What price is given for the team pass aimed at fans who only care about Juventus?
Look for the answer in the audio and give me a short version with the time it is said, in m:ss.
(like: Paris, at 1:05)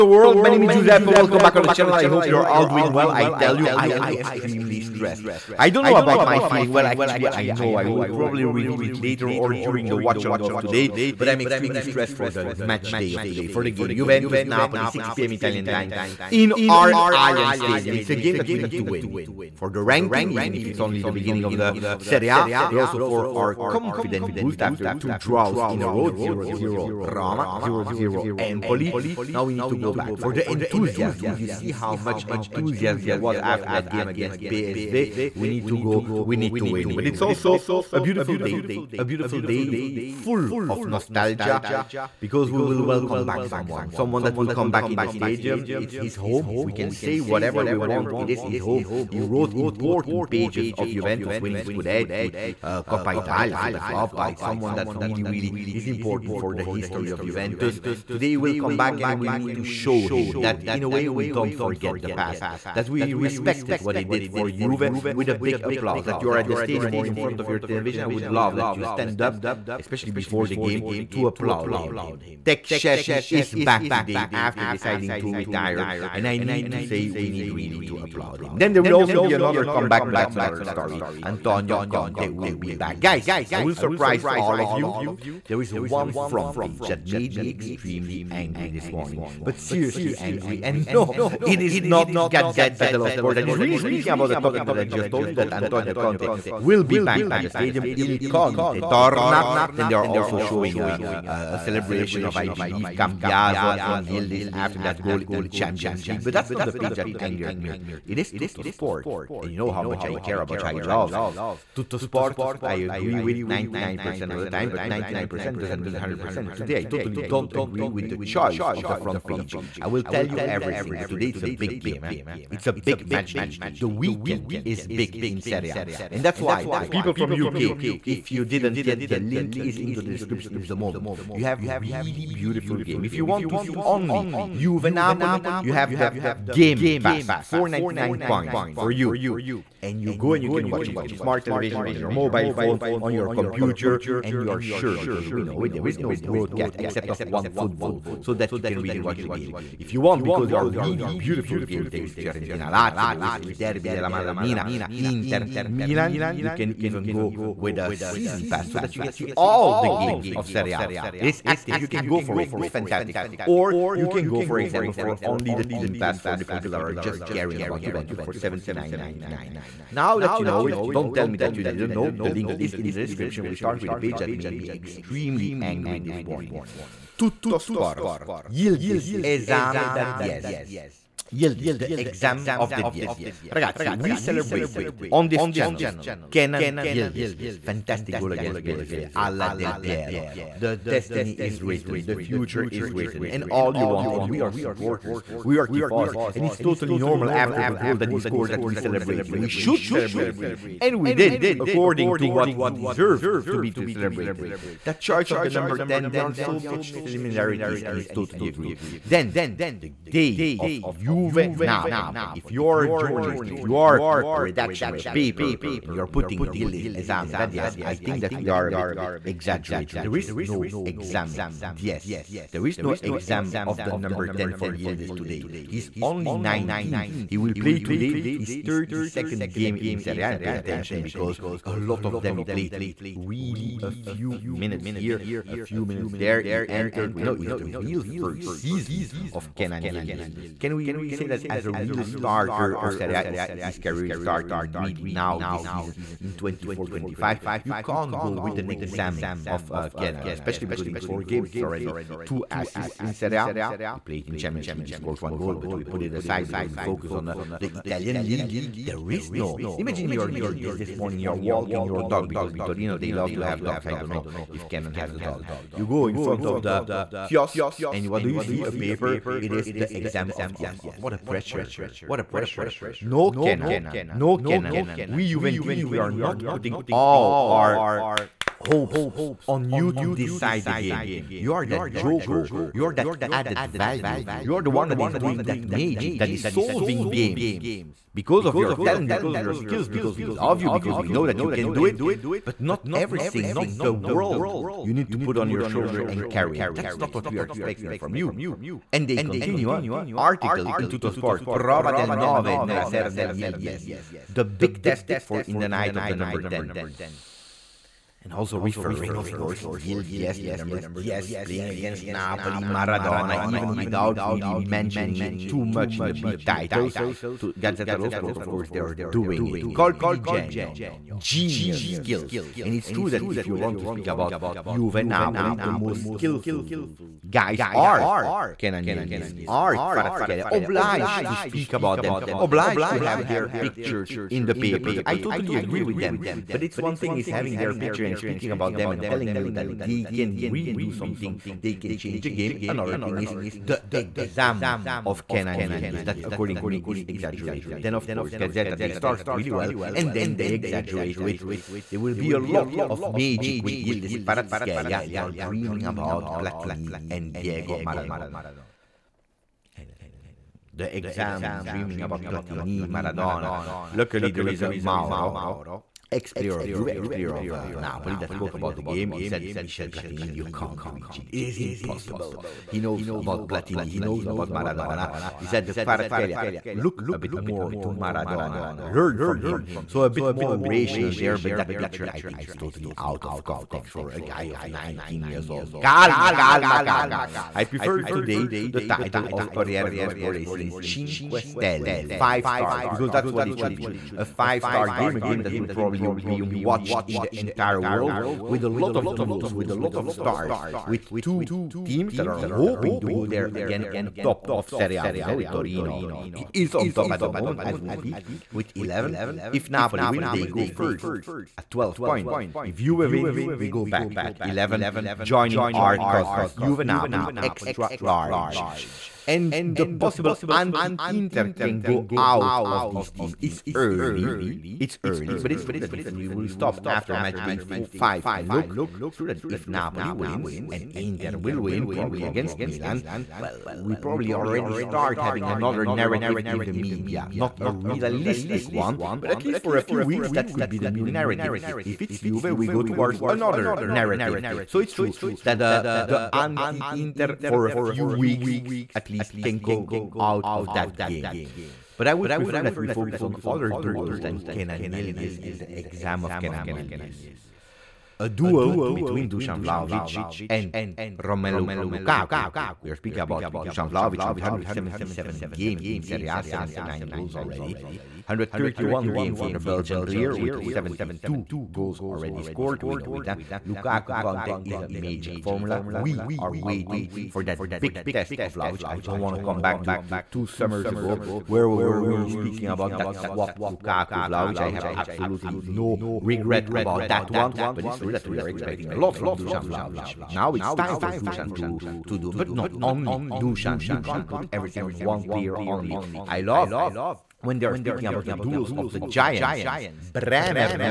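79.99, at 2:48.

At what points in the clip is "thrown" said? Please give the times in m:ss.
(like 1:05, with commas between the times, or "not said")
not said.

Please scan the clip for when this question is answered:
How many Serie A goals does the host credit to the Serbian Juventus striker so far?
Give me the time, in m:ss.
7:46.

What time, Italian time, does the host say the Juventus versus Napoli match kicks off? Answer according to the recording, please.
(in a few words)
6pm.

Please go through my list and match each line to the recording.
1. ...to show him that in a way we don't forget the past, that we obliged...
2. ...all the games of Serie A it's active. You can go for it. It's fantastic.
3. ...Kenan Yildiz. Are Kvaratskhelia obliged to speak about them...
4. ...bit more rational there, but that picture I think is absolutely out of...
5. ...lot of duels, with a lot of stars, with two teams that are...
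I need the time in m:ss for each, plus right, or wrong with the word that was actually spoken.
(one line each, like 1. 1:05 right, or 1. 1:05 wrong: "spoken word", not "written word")
1. 0:59 wrong: "respected", not "obliged"
2. 2:39 right
3. 5:28 right
4. 6:20 wrong: "totally", not "absolutely"
5. 6:38 right.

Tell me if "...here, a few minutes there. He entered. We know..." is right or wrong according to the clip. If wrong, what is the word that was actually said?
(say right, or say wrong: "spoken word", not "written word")
right.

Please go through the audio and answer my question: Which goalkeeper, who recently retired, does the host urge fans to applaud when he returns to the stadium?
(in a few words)
Szczęsny.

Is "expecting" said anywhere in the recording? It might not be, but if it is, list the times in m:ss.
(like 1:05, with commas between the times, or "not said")
4:57, 8:08.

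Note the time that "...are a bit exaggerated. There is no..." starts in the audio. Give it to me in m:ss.
3:38.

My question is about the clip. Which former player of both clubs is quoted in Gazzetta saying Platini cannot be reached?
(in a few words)
Mauro.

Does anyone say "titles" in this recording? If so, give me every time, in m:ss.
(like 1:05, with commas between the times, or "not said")
5:16, 6:28.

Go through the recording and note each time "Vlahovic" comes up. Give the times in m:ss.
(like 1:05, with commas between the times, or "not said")
7:39, 7:43, 8:04, 8:09.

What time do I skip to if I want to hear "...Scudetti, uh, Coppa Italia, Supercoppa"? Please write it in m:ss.
0:51.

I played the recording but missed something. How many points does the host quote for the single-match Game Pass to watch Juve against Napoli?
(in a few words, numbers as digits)
499.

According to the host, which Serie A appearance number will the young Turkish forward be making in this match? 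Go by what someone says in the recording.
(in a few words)
32nd.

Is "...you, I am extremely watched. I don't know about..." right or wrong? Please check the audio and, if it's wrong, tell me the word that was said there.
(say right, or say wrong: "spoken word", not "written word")
wrong: "stressed", not "watched".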